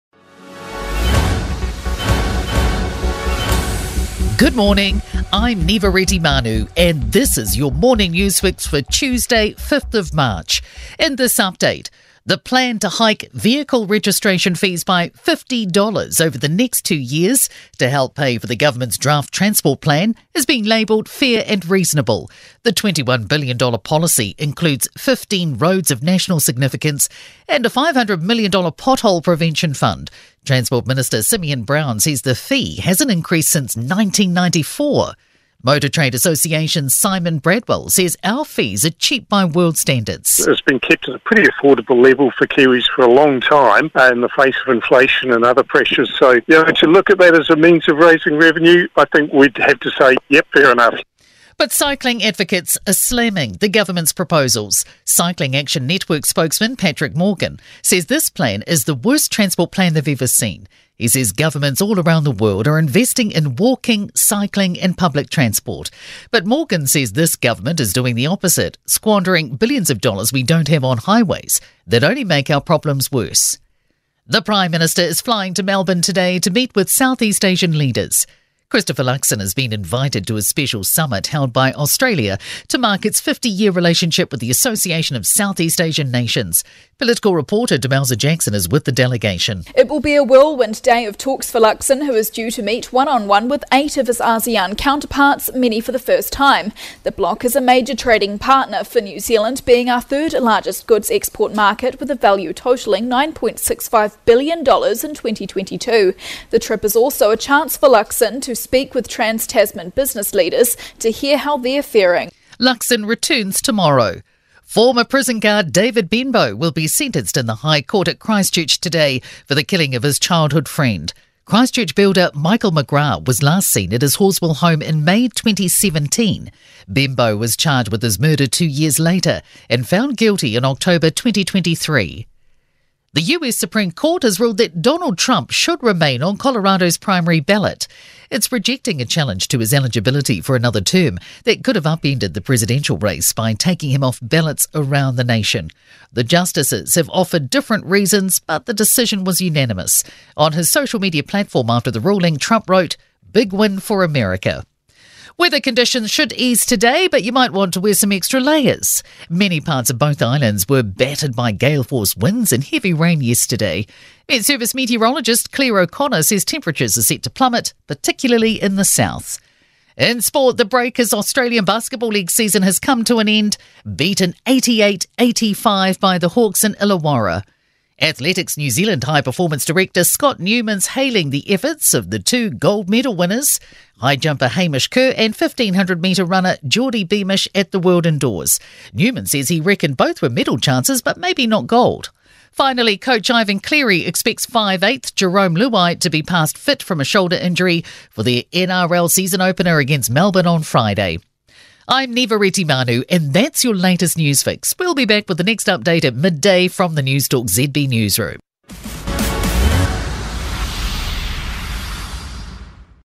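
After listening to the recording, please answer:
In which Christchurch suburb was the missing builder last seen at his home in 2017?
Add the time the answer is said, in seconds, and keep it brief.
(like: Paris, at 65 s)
Horswell, at 124 s.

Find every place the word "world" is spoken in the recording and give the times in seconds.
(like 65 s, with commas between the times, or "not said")
39 s, 62 s, 187 s.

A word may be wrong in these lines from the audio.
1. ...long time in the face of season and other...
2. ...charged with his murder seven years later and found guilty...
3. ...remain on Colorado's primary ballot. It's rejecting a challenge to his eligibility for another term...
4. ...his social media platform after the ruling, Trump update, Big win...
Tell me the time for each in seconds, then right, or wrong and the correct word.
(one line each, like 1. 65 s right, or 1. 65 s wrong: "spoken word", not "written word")
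1. 43 s wrong: "inflation", not "season"
2. 127 s wrong: "two", not "seven"
3. 135 s right
4. 150 s wrong: "wrote", not "update".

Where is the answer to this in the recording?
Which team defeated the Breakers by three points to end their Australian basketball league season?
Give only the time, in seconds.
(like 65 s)
176 s.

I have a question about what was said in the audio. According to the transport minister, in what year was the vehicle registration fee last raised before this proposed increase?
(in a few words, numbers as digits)
1994.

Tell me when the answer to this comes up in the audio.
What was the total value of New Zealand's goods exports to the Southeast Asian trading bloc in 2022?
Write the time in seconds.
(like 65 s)
103 s.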